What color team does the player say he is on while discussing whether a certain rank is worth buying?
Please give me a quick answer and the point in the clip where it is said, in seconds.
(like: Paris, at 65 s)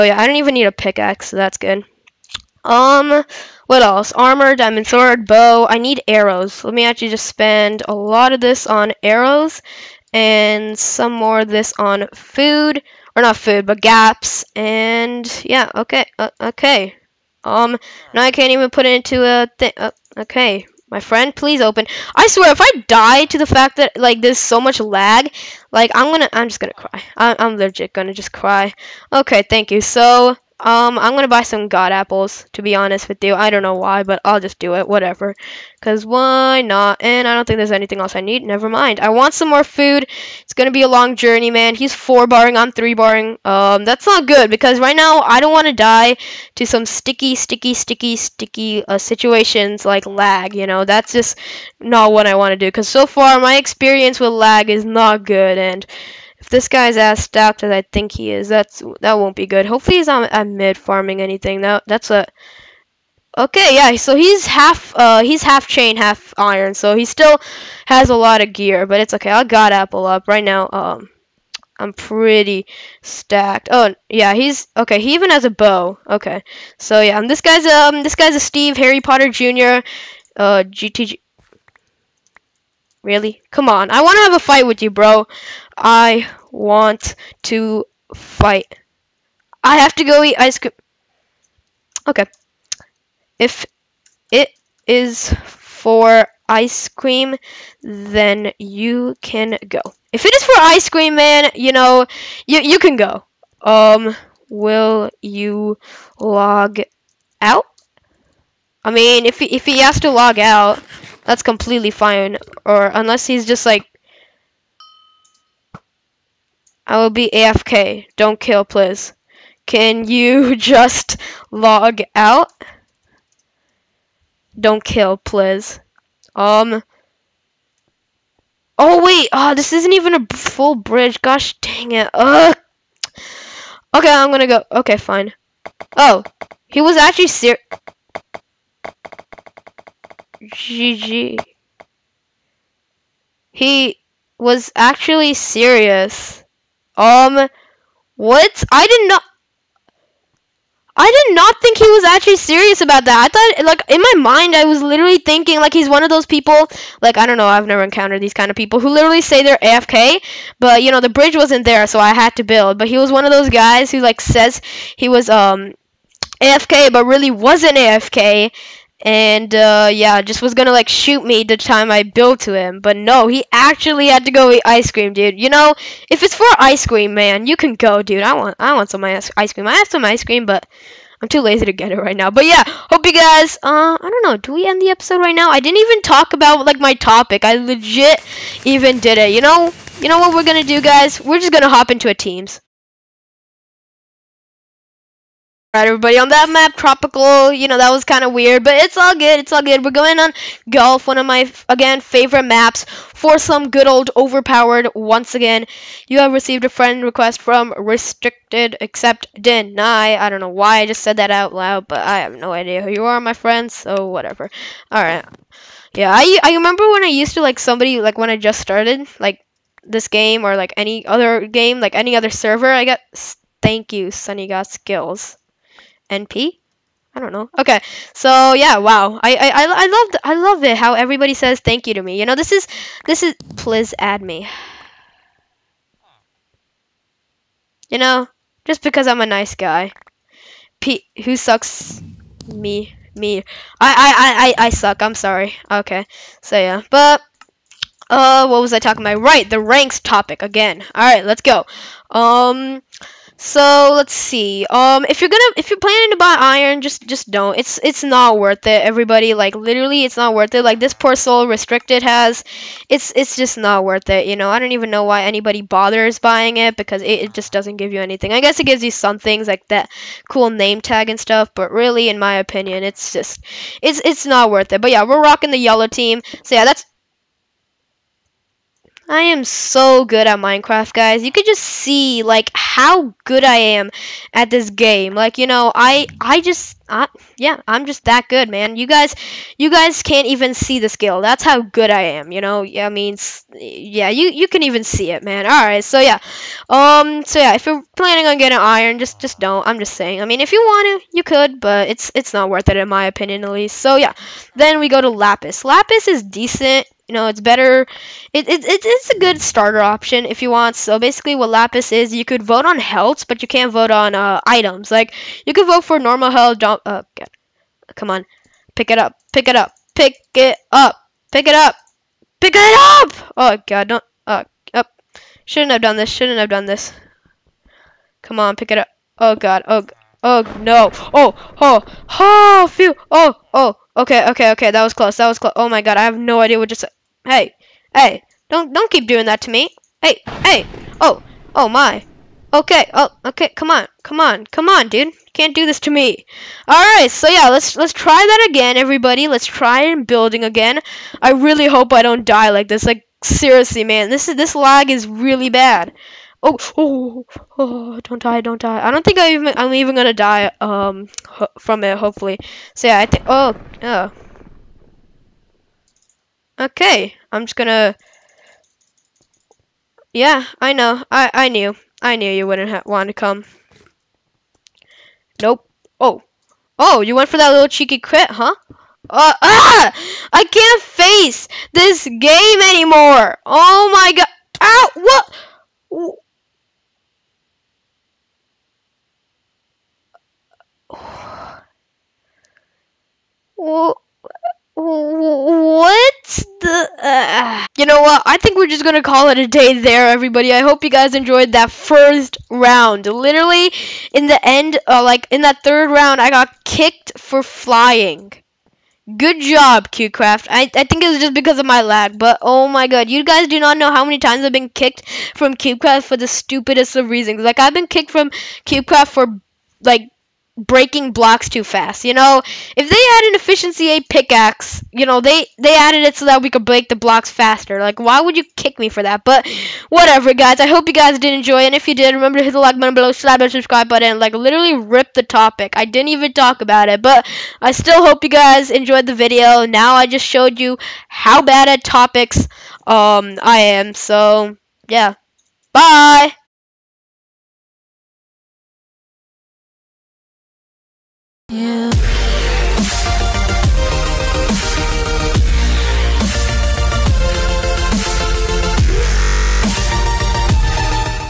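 yellow, at 275 s.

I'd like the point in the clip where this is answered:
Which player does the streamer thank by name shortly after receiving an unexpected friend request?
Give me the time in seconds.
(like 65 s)
224 s.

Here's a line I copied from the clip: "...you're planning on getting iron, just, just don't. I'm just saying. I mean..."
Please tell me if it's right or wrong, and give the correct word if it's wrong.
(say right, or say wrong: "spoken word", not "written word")
right.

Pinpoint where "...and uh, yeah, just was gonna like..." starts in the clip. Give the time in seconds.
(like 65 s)
169 s.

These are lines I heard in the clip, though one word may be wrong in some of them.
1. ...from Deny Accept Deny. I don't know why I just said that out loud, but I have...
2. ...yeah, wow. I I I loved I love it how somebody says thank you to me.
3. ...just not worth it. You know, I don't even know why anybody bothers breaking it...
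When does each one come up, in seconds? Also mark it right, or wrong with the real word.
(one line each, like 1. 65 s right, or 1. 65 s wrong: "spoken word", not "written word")
1. 207 s wrong: "Restricted", not "Deny"
2. 228 s wrong: "everybody", not "somebody"
3. 263 s wrong: "buying", not "breaking".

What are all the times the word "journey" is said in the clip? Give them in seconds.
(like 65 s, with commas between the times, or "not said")
41 s.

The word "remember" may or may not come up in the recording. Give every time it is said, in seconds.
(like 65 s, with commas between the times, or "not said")
216 s, 432 s.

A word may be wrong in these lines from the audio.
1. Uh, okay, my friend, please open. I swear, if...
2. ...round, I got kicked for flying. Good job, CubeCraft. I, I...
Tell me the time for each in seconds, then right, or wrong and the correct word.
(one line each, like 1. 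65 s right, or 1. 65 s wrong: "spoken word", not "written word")
1. 19 s right
2. 405 s right.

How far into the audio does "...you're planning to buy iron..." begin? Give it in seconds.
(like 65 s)
255 s.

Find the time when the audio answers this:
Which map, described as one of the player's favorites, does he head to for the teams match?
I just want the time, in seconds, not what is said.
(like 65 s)
200 s.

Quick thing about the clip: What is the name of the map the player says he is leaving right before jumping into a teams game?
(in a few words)
Tropical.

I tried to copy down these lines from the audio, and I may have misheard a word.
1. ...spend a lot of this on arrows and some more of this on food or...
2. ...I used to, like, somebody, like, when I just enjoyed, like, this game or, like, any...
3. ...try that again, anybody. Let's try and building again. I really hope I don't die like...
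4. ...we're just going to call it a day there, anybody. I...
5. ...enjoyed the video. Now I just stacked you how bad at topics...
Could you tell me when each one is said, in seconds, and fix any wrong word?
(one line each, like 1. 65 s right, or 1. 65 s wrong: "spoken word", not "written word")
1. 7 s right
2. 217 s wrong: "started", not "enjoyed"
3. 347 s wrong: "everybody", not "anybody"
4. 398 s wrong: "everybody", not "anybody"
5. 438 s wrong: "showed", not "stacked".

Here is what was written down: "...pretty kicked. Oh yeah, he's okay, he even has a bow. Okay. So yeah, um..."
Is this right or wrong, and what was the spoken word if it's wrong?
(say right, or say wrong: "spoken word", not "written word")
wrong: "stacked", not "kicked".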